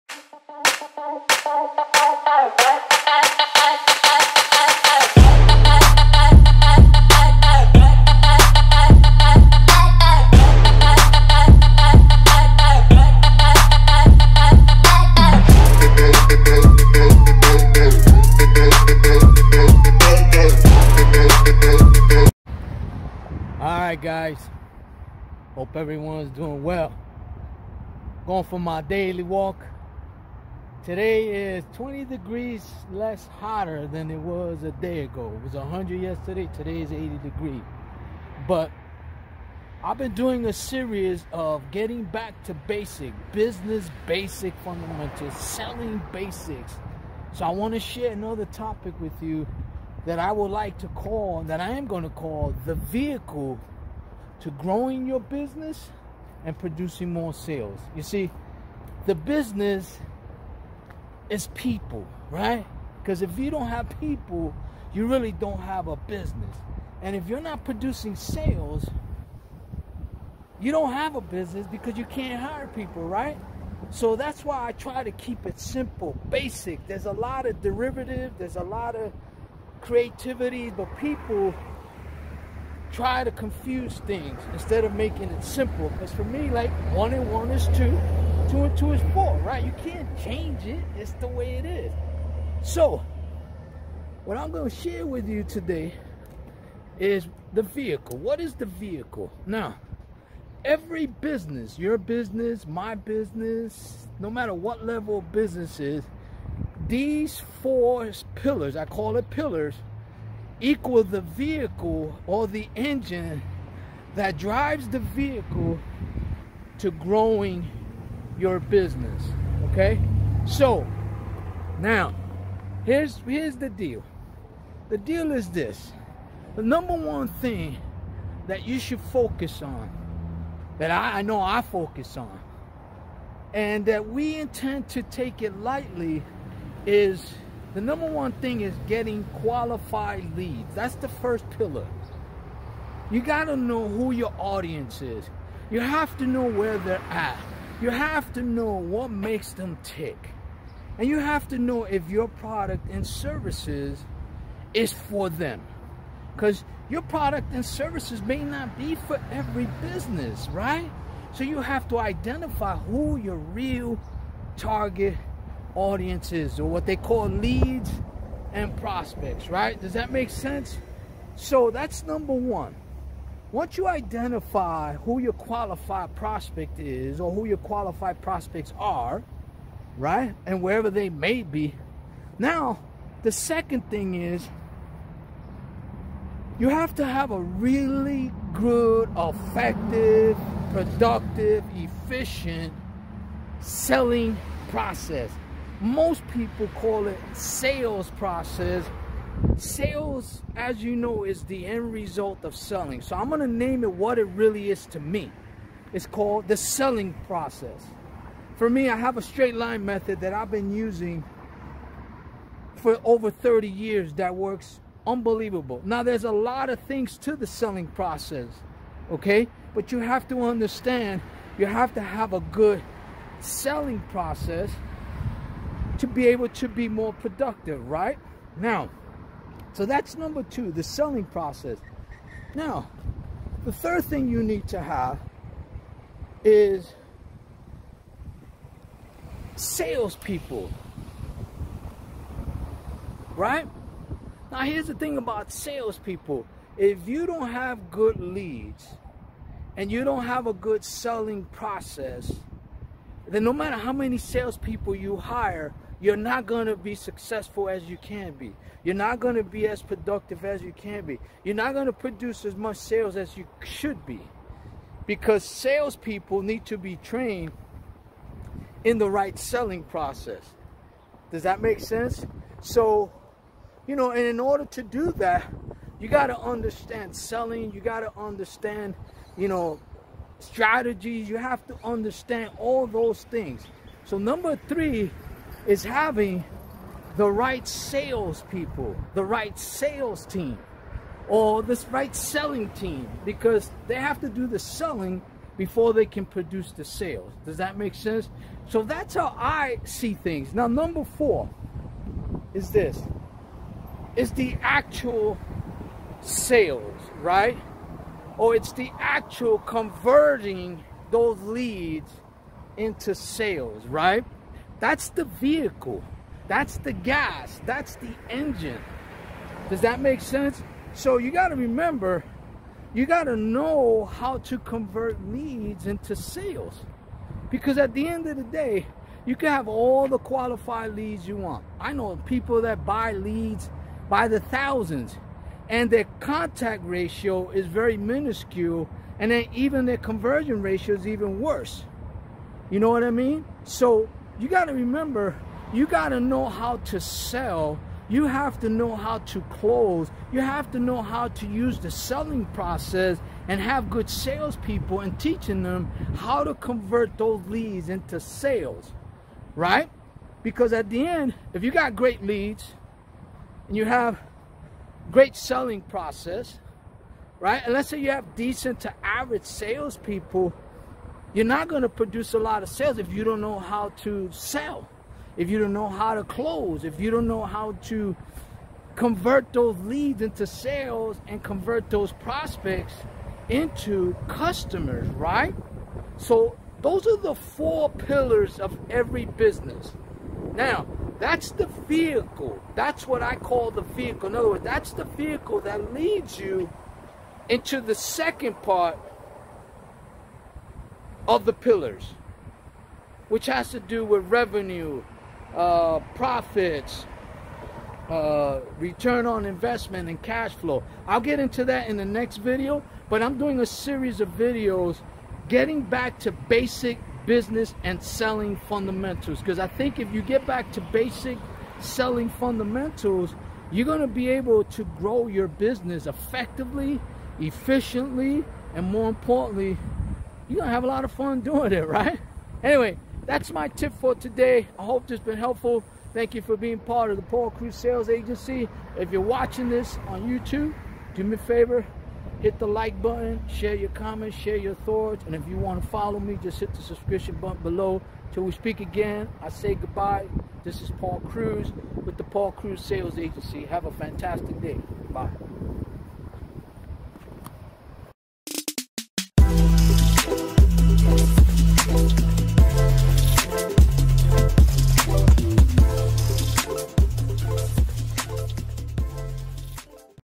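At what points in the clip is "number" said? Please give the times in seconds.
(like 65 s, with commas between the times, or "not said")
126 s, 137 s, 172 s, 230 s, 284 s, 300 s.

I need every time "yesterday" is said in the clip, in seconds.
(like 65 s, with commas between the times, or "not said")
36 s.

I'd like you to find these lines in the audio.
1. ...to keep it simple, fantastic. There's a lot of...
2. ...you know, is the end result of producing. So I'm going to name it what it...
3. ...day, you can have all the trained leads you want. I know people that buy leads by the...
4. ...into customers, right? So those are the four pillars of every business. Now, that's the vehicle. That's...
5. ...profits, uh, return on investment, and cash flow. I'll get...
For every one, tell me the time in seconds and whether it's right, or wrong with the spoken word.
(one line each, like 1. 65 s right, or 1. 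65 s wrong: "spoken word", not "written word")
1. 75 s wrong: "basic", not "fantastic"
2. 200 s wrong: "selling", not "producing"
3. 328 s wrong: "qualified", not "trained"
4. 383 s right
5. 406 s right.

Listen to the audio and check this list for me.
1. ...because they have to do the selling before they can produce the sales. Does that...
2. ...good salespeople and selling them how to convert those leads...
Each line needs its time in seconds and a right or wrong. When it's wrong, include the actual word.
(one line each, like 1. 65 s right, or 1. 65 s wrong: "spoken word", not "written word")
1. 293 s right
2. 353 s wrong: "teaching", not "selling".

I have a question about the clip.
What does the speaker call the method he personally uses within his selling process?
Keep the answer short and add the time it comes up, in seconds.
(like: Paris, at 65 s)
straight line method, at 209 s.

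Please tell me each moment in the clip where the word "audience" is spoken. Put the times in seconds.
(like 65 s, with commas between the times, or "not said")
144 s, 165 s.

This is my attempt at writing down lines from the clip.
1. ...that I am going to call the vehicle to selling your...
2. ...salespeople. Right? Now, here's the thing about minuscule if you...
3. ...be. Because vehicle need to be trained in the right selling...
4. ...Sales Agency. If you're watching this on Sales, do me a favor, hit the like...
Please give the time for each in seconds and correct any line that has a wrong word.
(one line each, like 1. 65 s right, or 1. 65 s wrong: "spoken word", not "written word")
1. 51 s wrong: "growing", not "selling"
2. 239 s wrong: "salespeople", not "minuscule"
3. 264 s wrong: "salespeople", not "vehicle"
4. 437 s wrong: "YouTube", not "Sales".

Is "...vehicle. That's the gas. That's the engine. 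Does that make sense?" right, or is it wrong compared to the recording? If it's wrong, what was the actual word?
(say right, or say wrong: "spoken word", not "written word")
right.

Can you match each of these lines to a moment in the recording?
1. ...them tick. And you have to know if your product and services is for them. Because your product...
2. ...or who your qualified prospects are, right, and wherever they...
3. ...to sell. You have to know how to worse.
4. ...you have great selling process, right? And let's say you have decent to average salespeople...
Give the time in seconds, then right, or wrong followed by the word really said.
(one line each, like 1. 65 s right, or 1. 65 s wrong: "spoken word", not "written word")
1. 149 s right
2. 177 s right
3. 346 s wrong: "close", not "worse"
4. 363 s right.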